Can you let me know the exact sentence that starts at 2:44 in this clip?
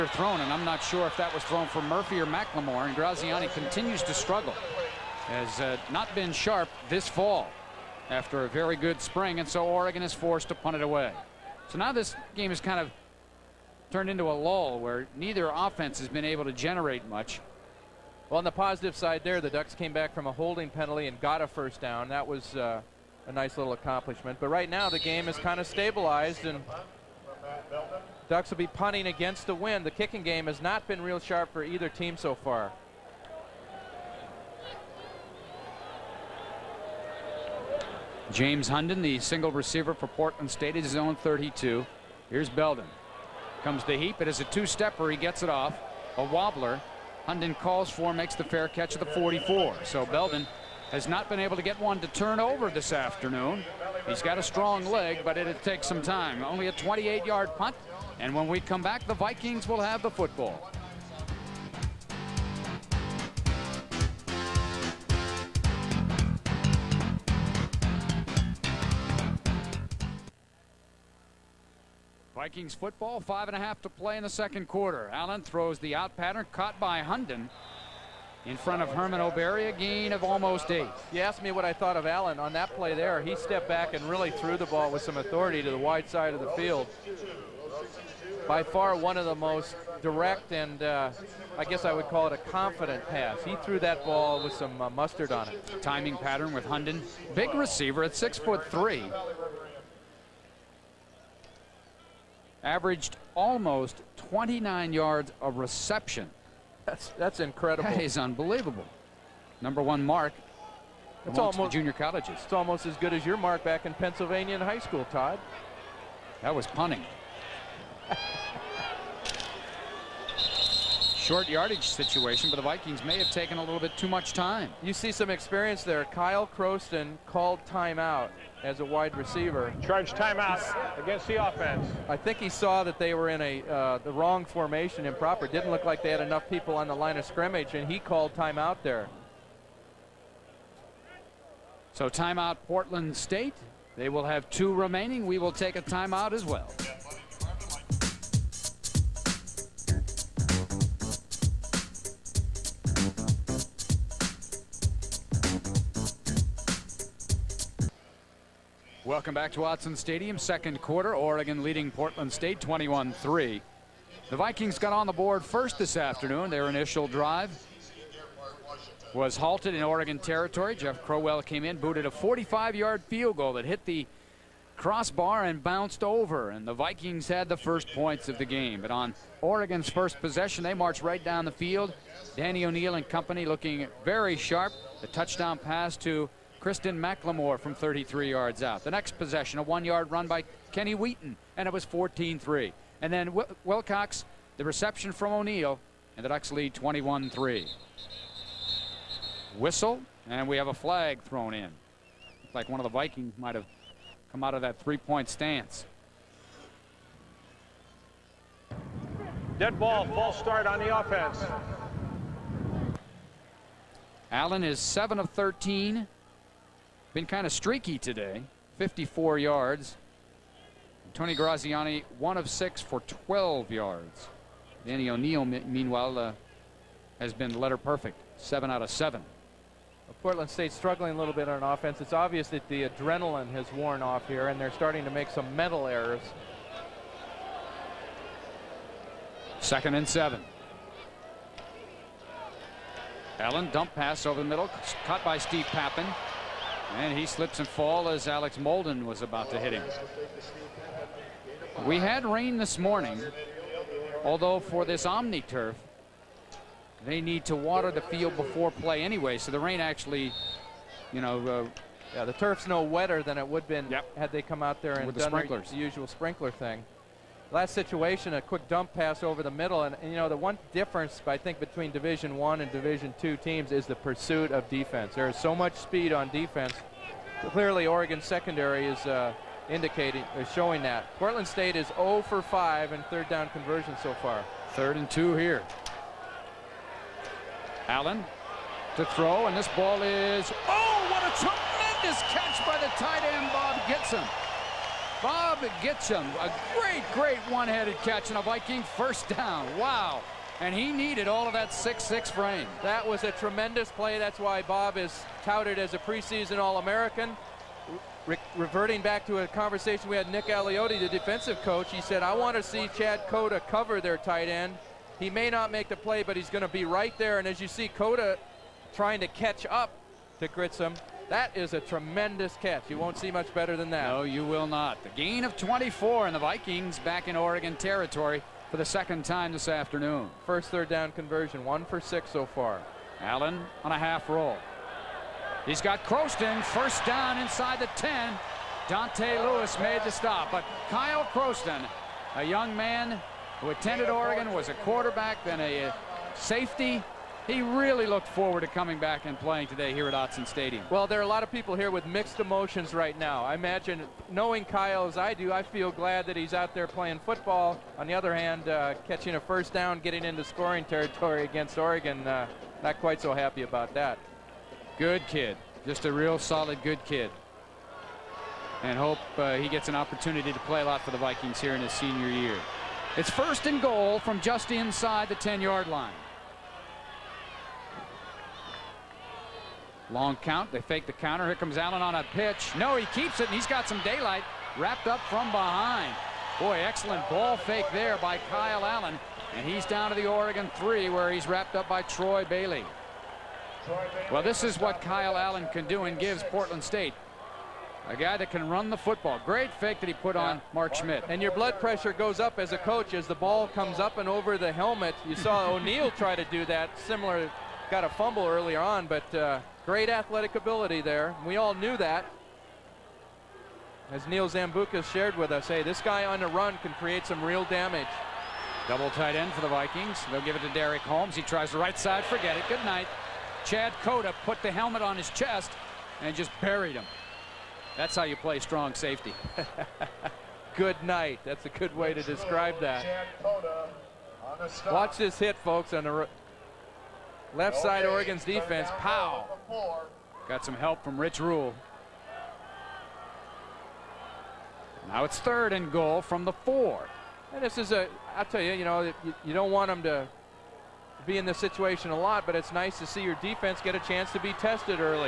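The Vikings got on the board first this afternoon.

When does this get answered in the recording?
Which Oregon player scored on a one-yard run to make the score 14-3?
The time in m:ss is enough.
3:10.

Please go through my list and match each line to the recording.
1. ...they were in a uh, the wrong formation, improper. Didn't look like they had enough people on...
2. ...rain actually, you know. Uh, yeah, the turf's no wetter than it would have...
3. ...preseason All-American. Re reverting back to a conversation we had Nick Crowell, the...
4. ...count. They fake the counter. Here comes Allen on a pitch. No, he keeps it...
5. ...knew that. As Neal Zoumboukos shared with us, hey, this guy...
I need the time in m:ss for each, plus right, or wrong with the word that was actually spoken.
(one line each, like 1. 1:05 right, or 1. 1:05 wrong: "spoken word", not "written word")
1. 2:12 right
2. 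4:19 right
3. 5:05 wrong: "Aliotti", not "Crowell"
4. 6:20 right
5. 6:51 right.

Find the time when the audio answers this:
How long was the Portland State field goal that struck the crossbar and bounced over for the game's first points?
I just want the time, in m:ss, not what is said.
2:52.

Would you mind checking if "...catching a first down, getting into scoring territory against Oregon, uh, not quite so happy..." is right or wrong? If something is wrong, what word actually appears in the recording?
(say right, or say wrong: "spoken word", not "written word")
right.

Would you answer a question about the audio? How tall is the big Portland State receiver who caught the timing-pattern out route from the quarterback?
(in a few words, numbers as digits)
6 foot 3.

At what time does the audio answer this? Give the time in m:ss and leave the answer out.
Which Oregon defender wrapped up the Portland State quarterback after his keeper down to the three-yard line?
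6:32.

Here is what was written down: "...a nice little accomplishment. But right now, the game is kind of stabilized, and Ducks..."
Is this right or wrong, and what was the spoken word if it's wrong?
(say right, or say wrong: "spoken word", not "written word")
right.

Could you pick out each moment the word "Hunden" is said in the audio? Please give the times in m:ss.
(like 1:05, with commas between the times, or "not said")
0:38, 0:47, 1:16, 1:36.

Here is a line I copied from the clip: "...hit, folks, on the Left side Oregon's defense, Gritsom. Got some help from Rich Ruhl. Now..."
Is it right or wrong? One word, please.
wrong.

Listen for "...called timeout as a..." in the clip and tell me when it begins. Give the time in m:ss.
2:07.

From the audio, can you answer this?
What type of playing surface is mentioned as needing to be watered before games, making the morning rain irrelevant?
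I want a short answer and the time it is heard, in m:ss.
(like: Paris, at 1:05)
Omni turf, at 4:15.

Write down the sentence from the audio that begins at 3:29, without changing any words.
Dead ball, false start on the offense.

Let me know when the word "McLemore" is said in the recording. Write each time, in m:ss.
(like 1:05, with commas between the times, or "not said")
0:02, 3:06.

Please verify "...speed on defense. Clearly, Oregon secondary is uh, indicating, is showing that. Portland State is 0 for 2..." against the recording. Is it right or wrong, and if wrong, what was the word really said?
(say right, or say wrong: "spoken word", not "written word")
wrong: "5", not "2".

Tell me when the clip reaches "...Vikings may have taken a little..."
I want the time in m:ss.
2:02.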